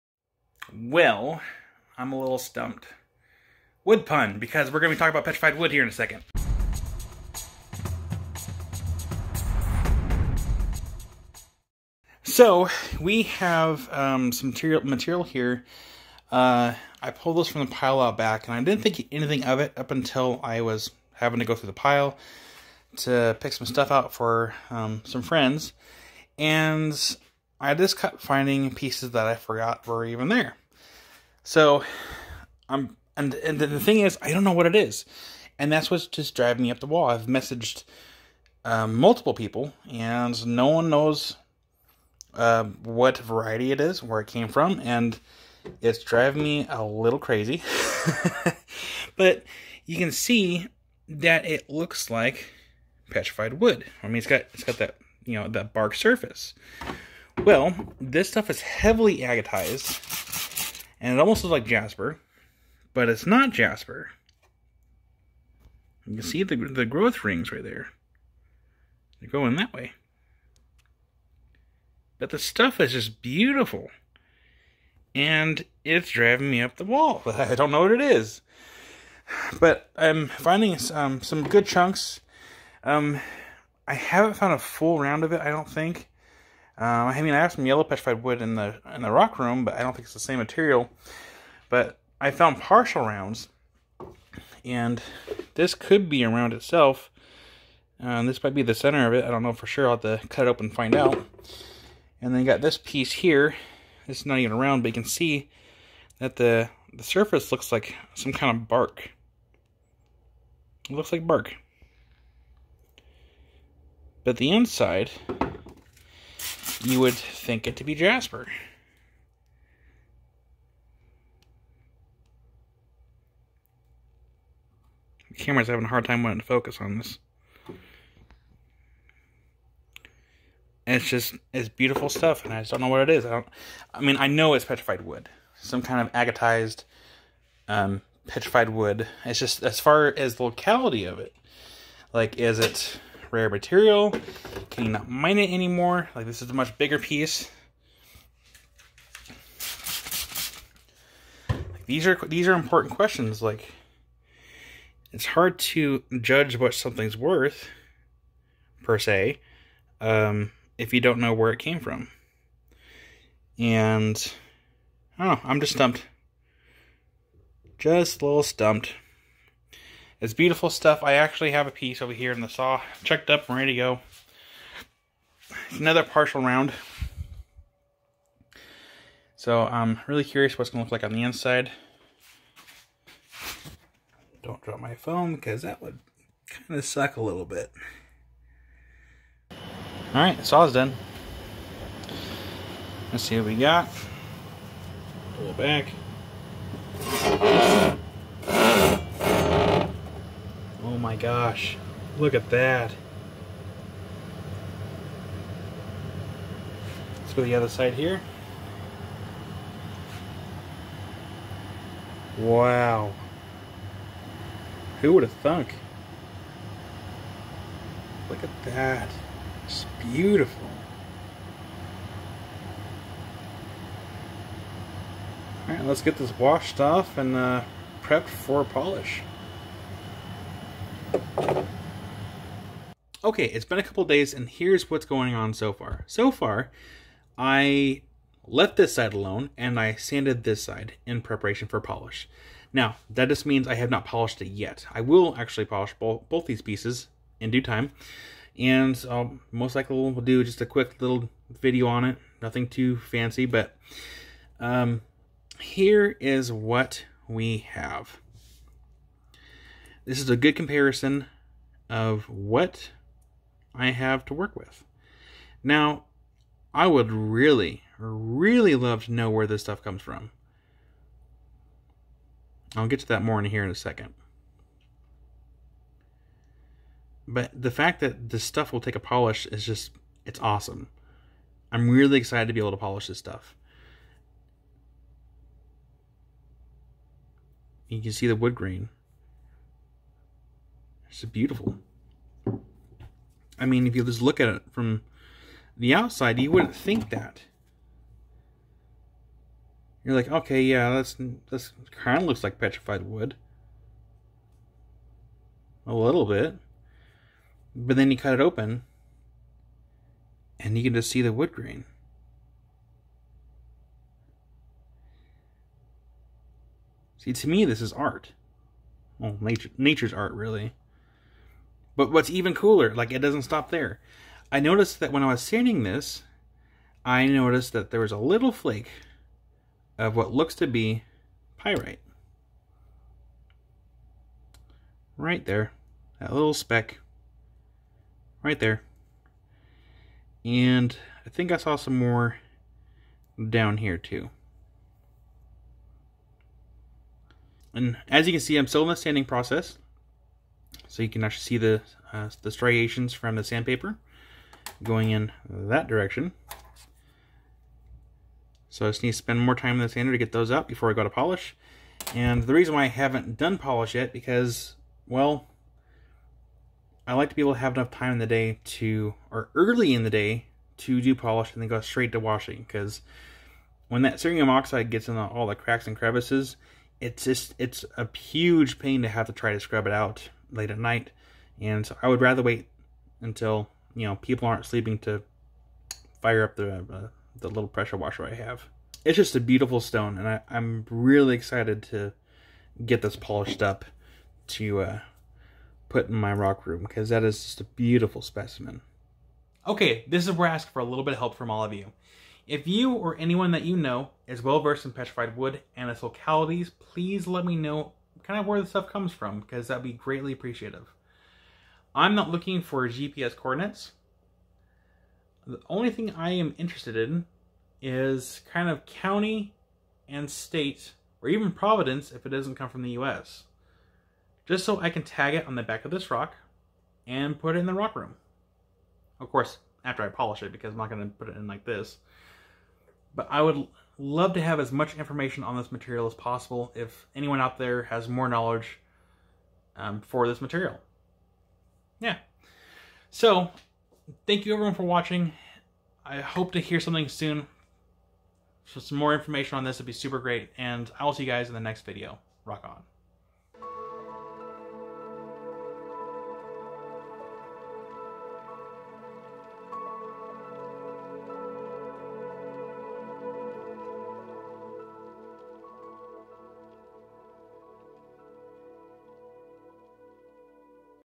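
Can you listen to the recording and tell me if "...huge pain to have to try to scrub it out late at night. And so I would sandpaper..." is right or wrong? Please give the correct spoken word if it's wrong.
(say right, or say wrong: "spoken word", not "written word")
wrong: "rather", not "sandpaper".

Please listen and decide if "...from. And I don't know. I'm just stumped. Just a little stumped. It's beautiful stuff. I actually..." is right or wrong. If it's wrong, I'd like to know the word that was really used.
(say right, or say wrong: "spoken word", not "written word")
right.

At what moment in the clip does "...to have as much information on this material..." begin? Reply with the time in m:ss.
7:14.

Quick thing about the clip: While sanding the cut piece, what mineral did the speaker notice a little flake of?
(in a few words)
Pyrite.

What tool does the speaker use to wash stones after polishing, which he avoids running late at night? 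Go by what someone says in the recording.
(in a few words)
Pressure washer.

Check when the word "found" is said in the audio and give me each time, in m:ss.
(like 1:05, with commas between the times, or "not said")
1:24, 1:32.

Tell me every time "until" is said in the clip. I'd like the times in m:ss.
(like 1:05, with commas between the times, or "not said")
0:19, 6:23.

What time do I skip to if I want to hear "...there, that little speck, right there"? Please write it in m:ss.
5:35.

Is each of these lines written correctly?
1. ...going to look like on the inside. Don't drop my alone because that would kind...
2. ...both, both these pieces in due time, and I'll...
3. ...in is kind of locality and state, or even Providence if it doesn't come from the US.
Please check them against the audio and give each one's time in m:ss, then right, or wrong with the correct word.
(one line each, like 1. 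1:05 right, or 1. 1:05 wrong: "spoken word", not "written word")
1. 3:00 wrong: "phone", not "alone"
2. 4:05 right
3. 6:56 wrong: "county", not "locality".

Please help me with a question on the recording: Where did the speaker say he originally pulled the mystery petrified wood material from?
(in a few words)
The pile out back.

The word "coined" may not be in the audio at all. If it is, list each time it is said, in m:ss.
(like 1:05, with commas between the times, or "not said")
not said.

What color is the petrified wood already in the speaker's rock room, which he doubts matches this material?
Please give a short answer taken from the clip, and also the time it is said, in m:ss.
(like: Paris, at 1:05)
Yellow, at 1:27.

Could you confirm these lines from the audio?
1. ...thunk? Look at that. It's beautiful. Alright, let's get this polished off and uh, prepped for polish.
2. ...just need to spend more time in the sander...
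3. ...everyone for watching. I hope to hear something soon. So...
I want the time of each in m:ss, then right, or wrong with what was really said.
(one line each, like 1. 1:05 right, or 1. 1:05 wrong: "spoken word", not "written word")
1. 3:35 wrong: "washed", not "polished"
2. 5:58 right
3. 7:24 right.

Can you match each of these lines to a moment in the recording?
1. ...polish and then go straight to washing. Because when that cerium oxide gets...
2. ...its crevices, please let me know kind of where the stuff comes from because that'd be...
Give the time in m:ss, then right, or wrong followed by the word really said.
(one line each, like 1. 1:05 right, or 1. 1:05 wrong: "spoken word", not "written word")
1. 6:11 right
2. 6:45 wrong: "localities", not "crevices".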